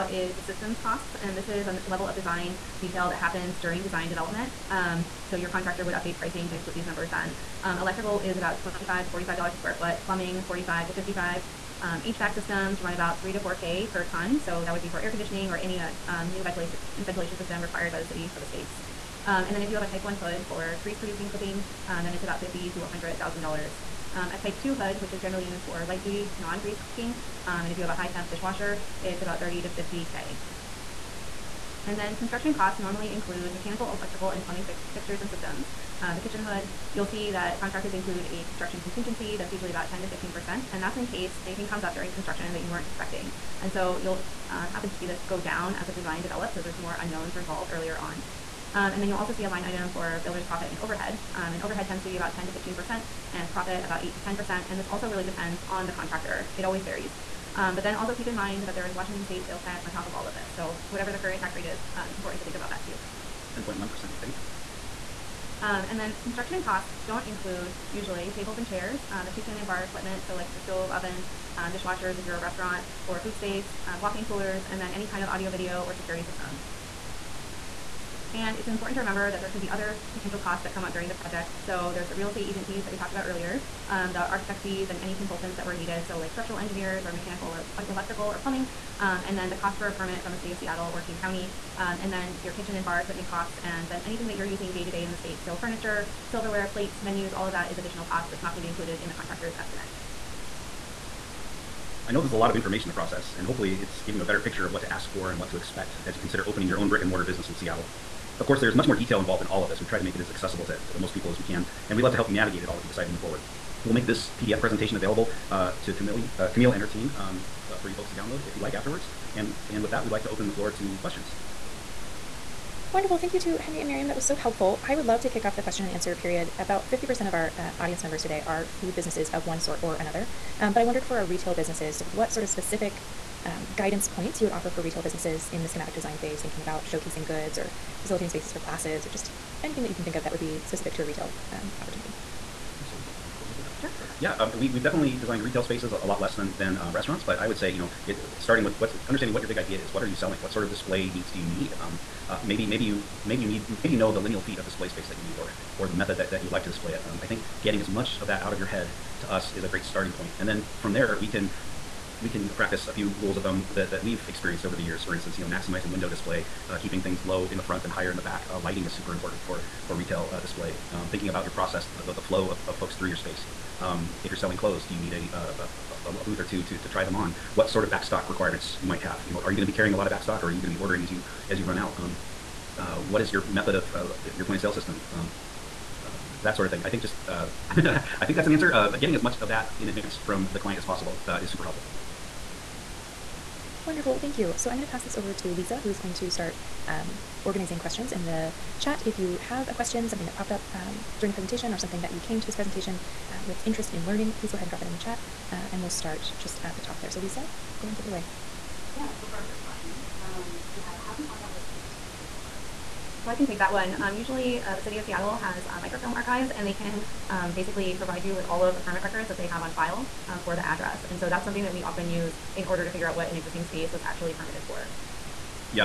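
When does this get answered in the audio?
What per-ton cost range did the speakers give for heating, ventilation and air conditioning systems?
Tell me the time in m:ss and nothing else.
0:13.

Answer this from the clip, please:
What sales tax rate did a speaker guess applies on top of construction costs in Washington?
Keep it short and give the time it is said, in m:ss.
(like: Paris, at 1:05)
10.1%, at 1:03.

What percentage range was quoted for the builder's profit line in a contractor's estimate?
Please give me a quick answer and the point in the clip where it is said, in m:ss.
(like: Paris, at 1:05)
8 to 10%, at 0:54.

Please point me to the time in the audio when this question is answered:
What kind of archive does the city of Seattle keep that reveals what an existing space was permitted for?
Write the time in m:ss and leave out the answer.
3:35.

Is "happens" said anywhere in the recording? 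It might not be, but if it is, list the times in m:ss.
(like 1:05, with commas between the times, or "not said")
0:03, 0:44.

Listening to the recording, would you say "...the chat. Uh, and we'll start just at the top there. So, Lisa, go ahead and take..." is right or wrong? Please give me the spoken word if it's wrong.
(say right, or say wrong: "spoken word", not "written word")
right.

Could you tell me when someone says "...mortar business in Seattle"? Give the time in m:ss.
1:47.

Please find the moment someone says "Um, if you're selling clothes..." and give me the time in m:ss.
2:53.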